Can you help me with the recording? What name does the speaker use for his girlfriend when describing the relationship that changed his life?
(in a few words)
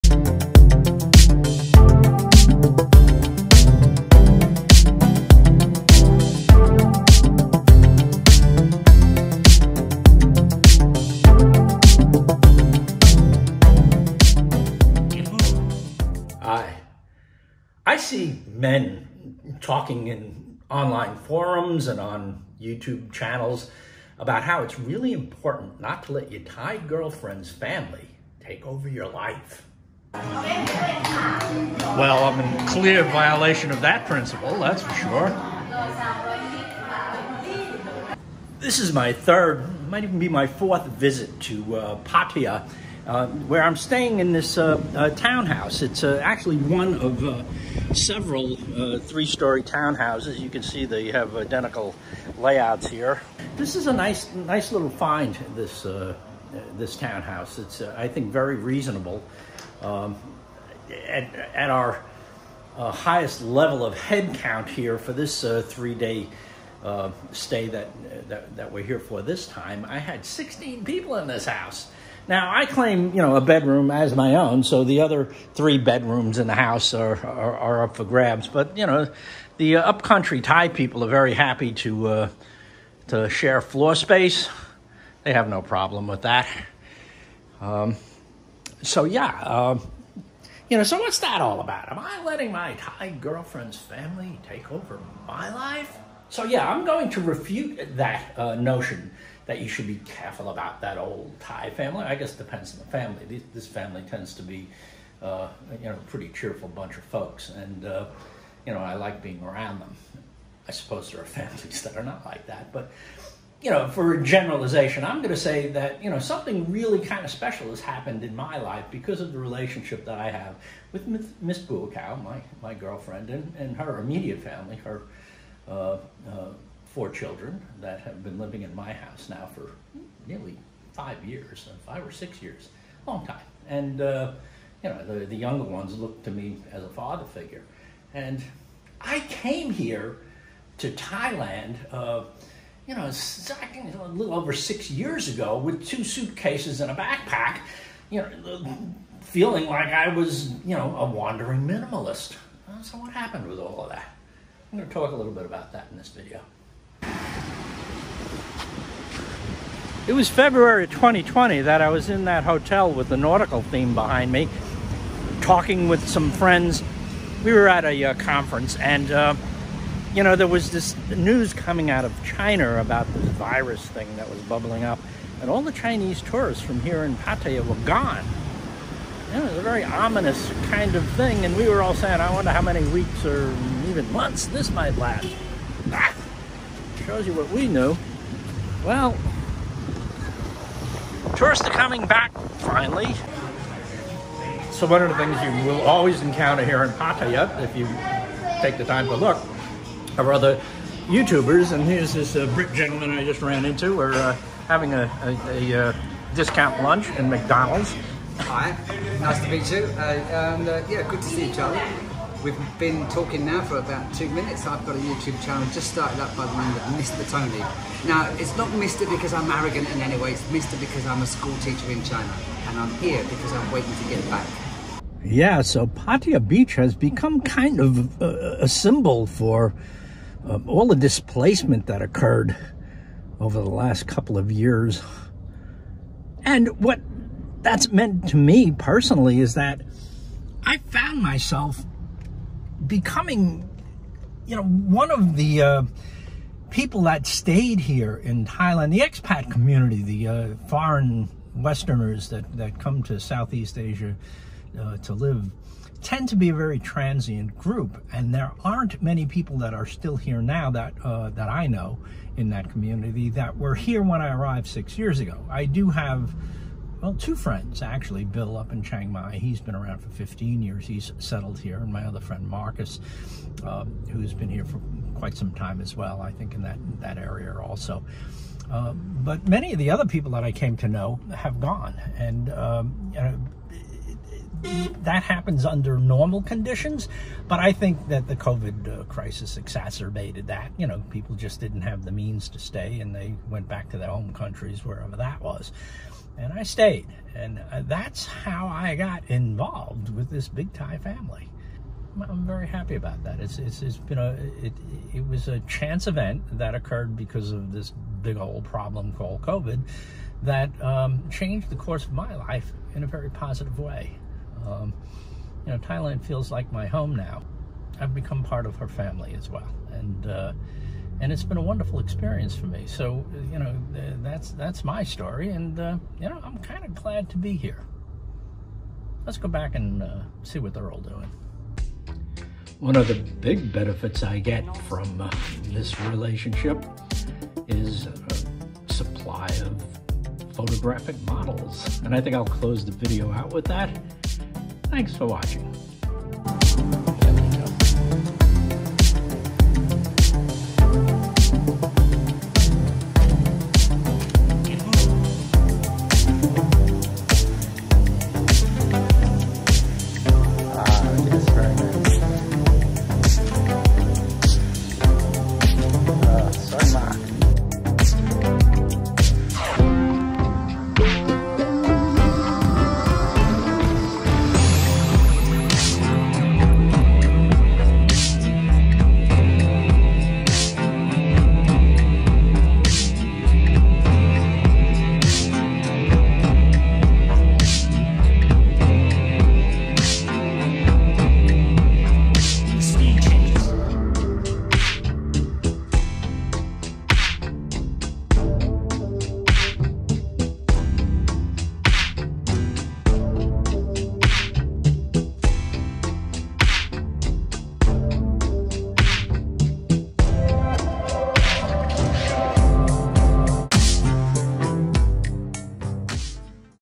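Miss Bua Khao.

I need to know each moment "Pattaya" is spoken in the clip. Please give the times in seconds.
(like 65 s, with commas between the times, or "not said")
42 s, 177 s, 196 s, 225 s.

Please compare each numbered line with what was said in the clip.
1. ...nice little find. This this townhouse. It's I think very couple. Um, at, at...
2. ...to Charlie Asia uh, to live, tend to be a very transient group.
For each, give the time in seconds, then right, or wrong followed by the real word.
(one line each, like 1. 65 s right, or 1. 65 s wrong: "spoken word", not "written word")
1. 54 s wrong: "reasonable", not "couple"
2. 253 s wrong: "Southeast", not "Charlie".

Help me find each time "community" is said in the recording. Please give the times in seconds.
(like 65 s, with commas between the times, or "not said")
249 s, 262 s.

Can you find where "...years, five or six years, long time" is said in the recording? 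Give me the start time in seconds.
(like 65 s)
131 s.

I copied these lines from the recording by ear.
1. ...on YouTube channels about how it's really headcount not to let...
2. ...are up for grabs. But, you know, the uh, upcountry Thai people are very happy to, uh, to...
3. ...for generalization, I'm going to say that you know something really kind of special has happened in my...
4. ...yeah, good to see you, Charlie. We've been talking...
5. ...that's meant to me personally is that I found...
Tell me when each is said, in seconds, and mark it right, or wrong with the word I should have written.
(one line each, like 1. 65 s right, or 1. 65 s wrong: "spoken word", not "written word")
1. 21 s wrong: "important", not "headcount"
2. 77 s right
3. 113 s right
4. 210 s right
5. 237 s right.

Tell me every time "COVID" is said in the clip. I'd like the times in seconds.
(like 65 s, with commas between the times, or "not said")
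288 s, 309 s.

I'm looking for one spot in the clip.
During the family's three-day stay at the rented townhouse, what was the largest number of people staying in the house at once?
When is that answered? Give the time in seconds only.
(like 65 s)
70 s.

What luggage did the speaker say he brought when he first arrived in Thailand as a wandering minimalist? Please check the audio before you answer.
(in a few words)
Two suitcases and a backpack.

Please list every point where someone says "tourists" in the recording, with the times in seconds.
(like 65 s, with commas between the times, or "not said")
176 s, 191 s.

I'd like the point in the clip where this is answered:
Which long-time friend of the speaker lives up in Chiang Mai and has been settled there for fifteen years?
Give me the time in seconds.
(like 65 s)
268 s.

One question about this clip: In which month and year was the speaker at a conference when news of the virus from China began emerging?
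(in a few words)
February 2020.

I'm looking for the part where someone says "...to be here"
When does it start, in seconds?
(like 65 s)
327 s.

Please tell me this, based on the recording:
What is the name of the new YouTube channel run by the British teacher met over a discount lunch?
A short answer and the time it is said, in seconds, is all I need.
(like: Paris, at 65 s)
Mr. Tony, at 216 s.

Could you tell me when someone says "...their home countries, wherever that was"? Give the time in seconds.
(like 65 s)
293 s.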